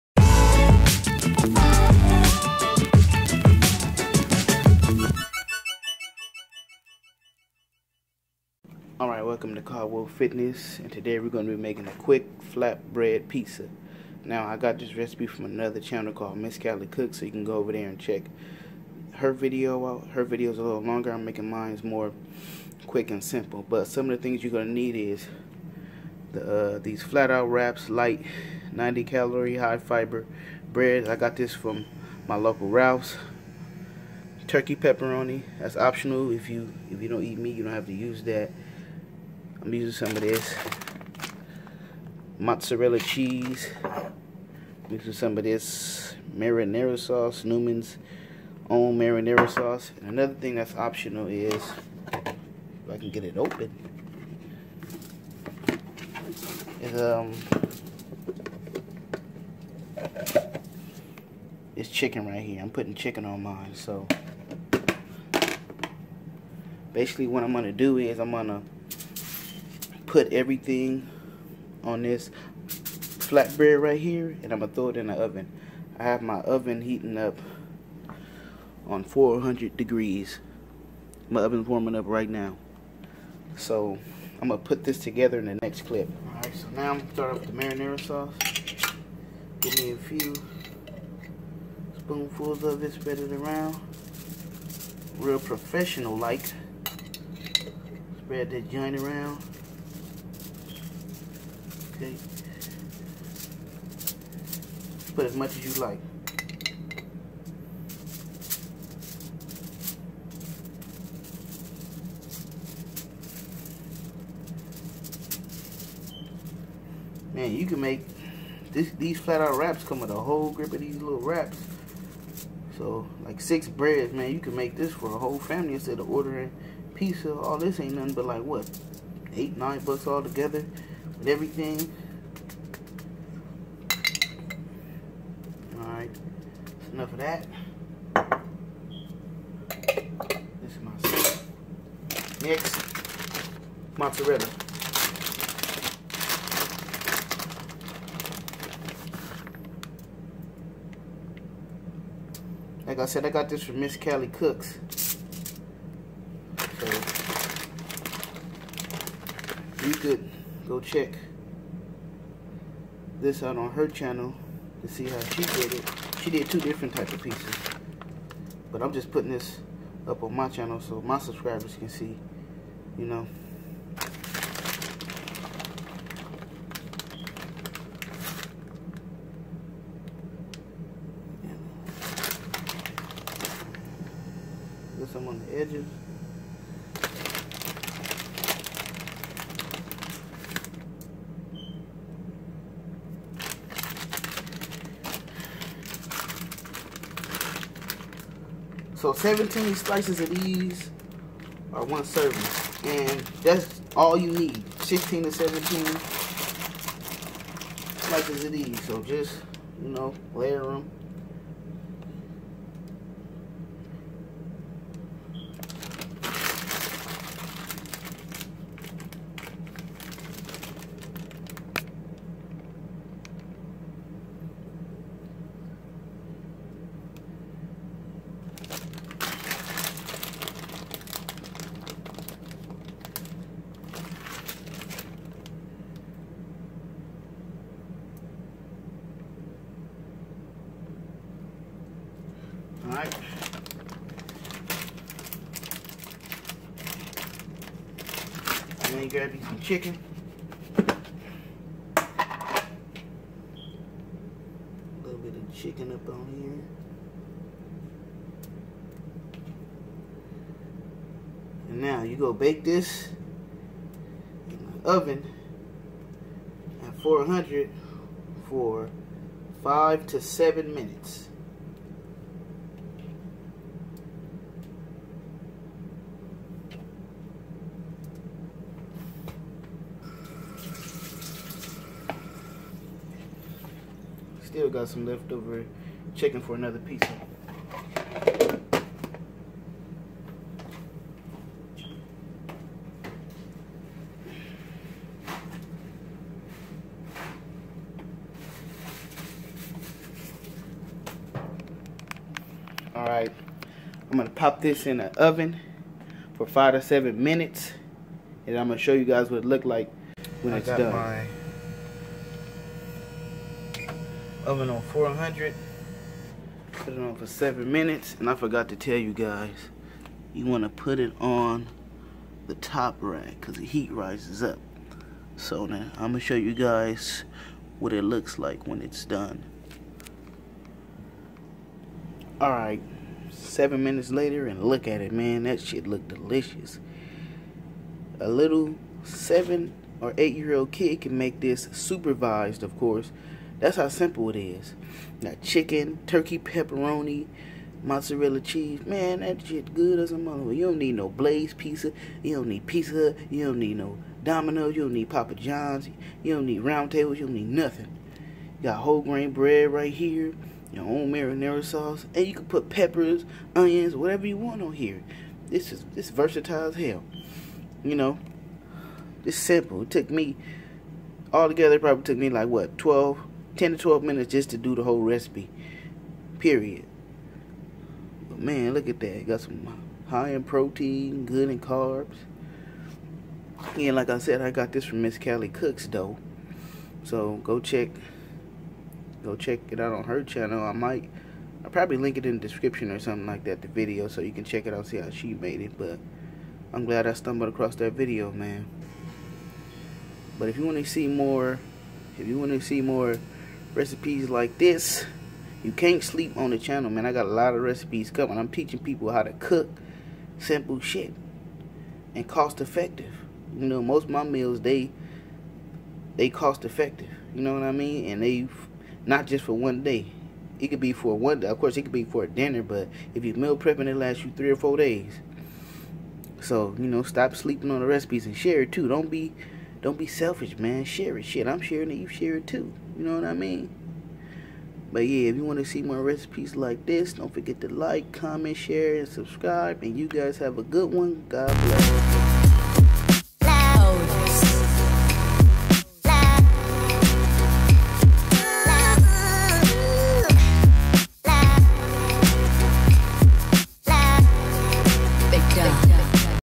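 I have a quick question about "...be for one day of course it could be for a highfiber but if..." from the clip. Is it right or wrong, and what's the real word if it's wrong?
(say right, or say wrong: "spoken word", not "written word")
wrong: "dinner", not "highfiber".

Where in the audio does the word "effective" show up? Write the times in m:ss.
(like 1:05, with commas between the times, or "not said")
6:52, 6:56.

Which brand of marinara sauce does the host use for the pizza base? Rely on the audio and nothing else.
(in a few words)
Newman's Own.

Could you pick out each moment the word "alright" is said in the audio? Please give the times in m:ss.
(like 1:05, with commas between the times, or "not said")
0:09, 2:15, 5:02, 5:32.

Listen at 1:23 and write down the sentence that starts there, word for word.
So I'm gonna put this together in the next clip.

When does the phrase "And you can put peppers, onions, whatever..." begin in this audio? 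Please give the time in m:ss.
6:02.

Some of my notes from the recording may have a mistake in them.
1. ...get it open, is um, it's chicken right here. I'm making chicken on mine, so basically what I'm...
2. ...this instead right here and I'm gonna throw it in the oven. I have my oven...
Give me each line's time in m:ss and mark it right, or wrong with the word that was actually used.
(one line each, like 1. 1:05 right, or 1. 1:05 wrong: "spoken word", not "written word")
1. 0:53 wrong: "putting", not "making"
2. 1:12 wrong: "flatbread", not "instead".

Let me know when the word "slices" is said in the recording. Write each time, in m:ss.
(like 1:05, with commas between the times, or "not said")
3:19, 3:27.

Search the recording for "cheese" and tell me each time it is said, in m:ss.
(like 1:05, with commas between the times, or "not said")
0:42, 5:48.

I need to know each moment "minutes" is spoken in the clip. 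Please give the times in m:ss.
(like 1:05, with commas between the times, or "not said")
4:30, 5:07, 5:17, 5:33, 6:14.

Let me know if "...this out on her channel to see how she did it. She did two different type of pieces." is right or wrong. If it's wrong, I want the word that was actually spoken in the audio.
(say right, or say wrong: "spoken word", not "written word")
right.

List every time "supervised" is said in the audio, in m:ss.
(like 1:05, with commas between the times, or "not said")
5:41.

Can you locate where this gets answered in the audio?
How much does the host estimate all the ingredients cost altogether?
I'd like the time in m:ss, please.
2:09.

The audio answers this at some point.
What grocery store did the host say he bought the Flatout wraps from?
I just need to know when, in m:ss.
0:32.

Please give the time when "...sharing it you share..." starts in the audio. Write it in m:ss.
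7:11.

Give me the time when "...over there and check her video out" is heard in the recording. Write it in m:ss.
0:17.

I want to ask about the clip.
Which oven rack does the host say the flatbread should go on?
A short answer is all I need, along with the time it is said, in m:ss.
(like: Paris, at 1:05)
top rack, at 5:22.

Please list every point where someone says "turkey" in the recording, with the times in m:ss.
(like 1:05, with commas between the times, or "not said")
0:34, 5:46.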